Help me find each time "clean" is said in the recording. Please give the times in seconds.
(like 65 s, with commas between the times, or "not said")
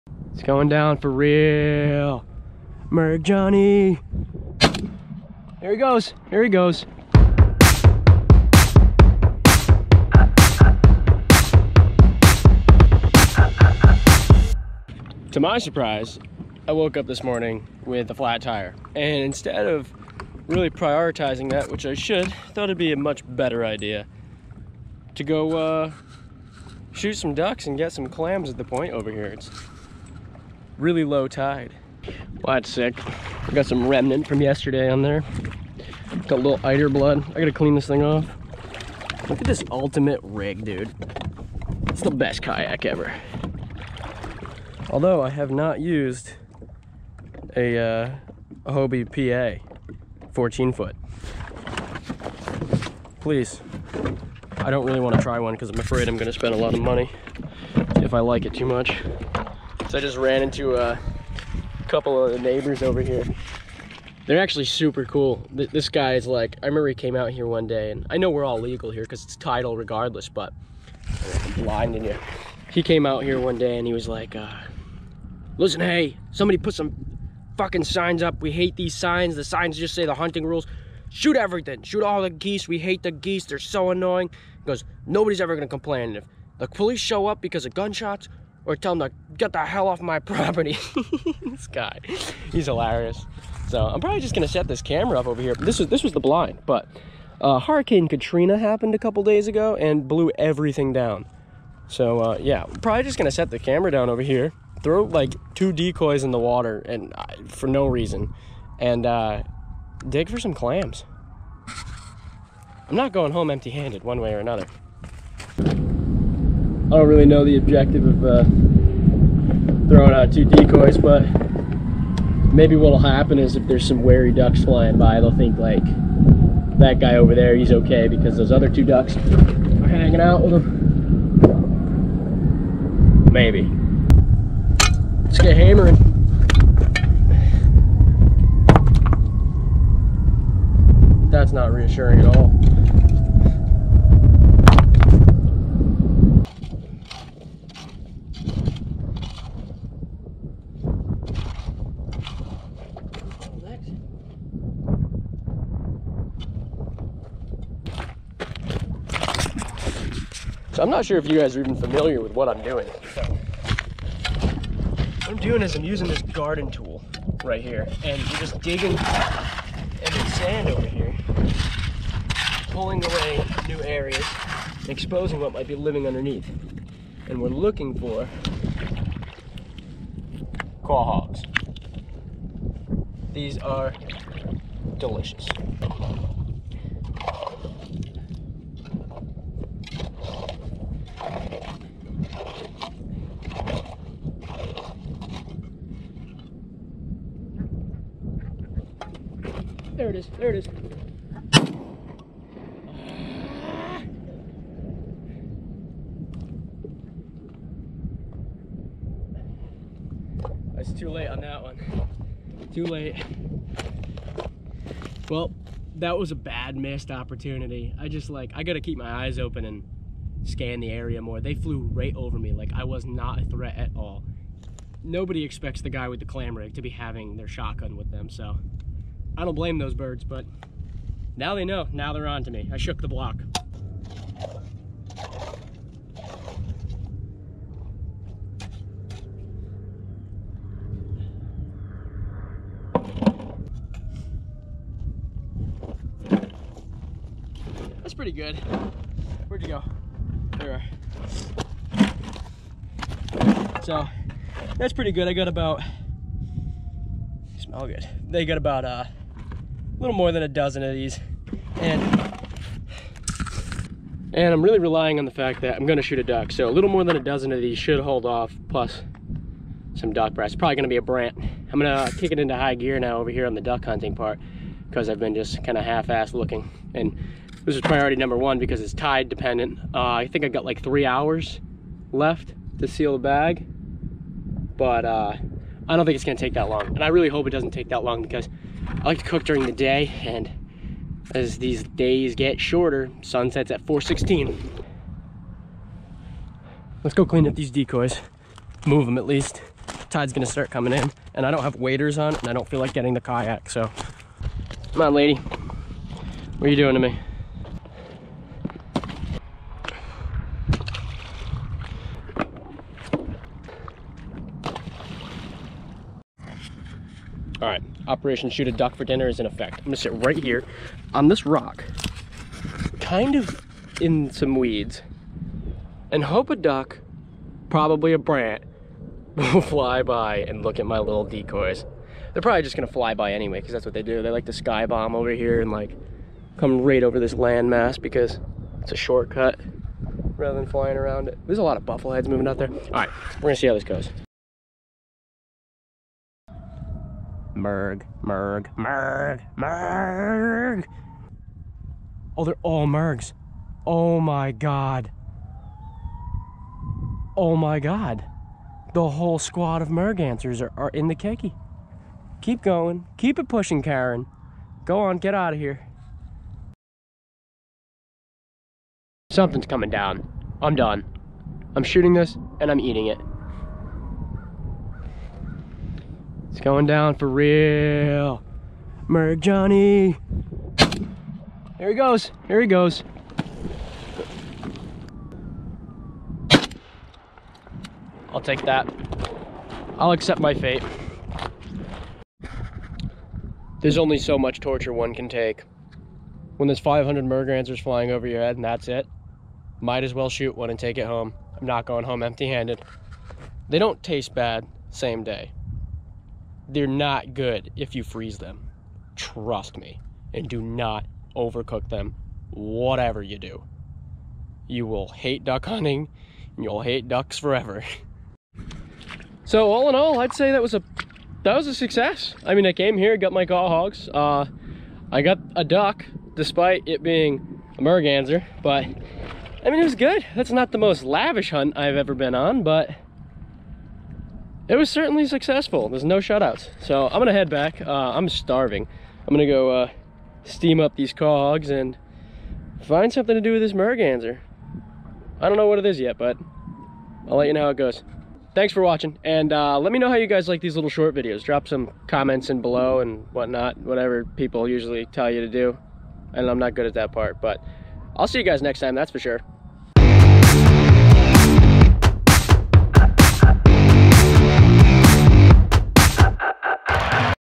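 37 s, 297 s.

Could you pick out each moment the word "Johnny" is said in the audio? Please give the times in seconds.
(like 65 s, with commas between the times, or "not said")
3 s, 379 s.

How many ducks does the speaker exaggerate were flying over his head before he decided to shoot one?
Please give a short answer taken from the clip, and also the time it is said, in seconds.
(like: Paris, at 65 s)
500, at 396 s.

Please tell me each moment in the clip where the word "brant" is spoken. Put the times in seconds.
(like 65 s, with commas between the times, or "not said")
271 s, 328 s.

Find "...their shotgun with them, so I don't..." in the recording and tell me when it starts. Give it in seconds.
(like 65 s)
227 s.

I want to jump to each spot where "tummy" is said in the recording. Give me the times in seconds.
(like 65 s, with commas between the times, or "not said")
not said.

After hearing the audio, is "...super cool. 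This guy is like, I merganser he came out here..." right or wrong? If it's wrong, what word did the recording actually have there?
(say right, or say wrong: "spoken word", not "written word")
wrong: "remember", not "merganser".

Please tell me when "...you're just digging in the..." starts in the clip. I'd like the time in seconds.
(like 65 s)
168 s.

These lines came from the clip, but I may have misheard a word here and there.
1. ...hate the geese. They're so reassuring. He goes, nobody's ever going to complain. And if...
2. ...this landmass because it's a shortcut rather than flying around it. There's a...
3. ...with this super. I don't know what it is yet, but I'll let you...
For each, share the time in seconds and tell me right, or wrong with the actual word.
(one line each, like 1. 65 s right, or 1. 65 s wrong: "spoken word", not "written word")
1. 82 s wrong: "annoying", not "reassuring"
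2. 337 s right
3. 443 s wrong: "merganser", not "super".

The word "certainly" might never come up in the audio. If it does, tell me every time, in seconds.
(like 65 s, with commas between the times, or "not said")
434 s.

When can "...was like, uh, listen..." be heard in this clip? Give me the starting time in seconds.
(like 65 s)
73 s.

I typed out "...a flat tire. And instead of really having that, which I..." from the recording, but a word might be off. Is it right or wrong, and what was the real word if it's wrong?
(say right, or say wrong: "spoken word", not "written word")
wrong: "prioritizing", not "having".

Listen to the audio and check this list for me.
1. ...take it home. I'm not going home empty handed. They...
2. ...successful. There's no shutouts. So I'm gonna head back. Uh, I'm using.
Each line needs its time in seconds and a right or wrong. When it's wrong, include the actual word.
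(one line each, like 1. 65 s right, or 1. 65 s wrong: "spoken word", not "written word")
1. 400 s right
2. 435 s wrong: "starving", not "using".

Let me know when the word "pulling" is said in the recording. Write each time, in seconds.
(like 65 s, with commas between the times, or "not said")
172 s.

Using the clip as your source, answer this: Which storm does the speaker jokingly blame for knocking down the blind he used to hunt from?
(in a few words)
Hurricane Katrina.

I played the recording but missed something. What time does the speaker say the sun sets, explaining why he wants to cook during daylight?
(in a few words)
4:16.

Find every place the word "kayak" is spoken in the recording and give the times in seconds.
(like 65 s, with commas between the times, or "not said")
42 s, 303 s.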